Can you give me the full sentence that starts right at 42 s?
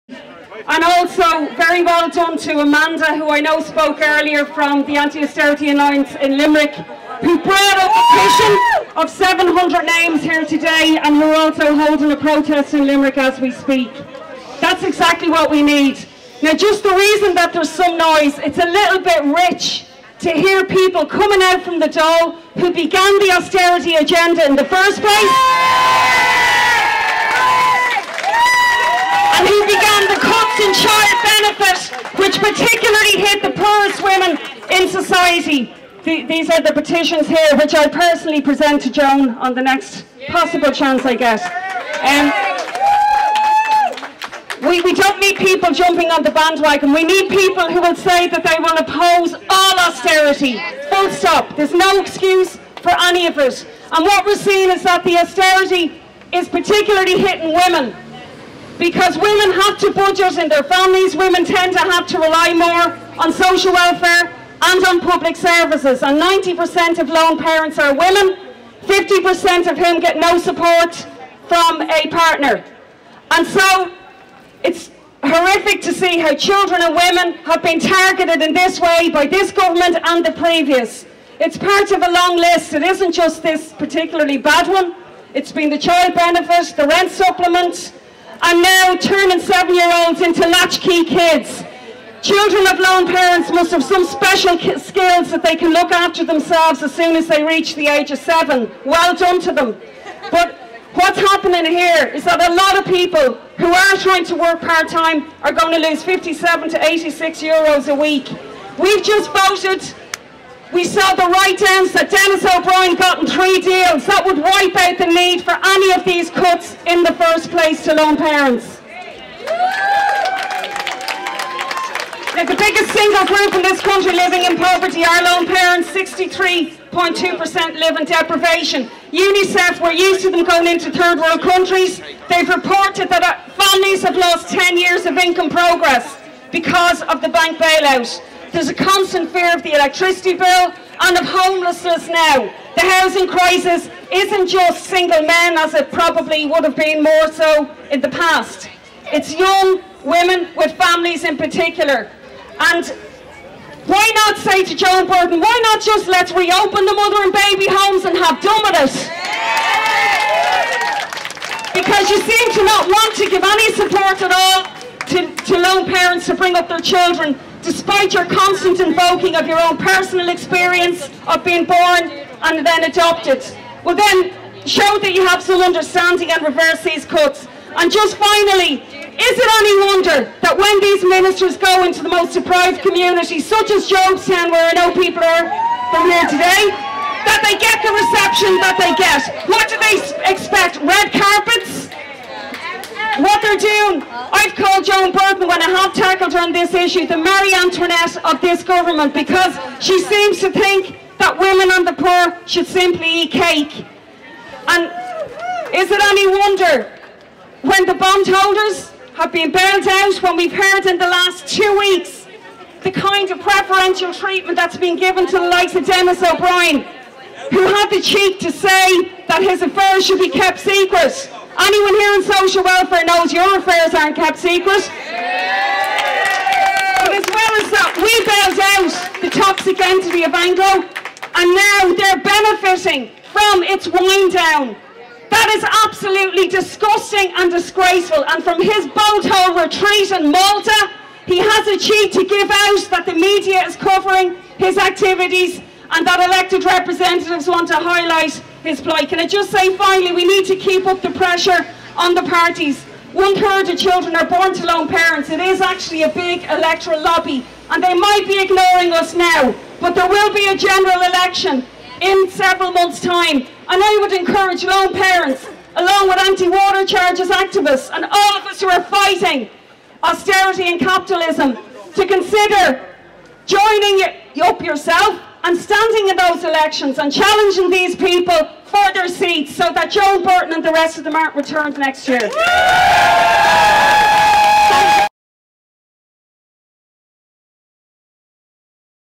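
Um, we, we don't need people jumping on the bandwagon.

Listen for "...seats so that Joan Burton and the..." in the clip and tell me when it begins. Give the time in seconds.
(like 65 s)
279 s.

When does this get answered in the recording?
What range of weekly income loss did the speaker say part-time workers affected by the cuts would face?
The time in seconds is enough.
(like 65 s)
106 s.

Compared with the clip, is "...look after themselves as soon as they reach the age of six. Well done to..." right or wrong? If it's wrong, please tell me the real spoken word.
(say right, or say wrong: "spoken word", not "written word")
wrong: "seven", not "six".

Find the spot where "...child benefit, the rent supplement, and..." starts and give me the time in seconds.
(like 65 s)
85 s.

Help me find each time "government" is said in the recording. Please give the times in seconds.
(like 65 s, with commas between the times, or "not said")
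79 s, 198 s.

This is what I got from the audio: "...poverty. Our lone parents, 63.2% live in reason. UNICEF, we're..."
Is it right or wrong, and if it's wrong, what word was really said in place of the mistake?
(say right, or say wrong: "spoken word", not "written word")
wrong: "deprivation", not "reason".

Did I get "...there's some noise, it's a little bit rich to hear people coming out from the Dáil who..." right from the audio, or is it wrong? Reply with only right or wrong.
right.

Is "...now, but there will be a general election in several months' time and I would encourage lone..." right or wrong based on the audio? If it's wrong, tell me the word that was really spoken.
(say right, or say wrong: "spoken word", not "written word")
right.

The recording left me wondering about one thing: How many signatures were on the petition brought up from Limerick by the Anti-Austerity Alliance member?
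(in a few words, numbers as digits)
700.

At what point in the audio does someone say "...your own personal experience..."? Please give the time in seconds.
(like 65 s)
169 s.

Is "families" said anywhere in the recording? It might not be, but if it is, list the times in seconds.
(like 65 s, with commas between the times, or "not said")
60 s, 133 s, 150 s.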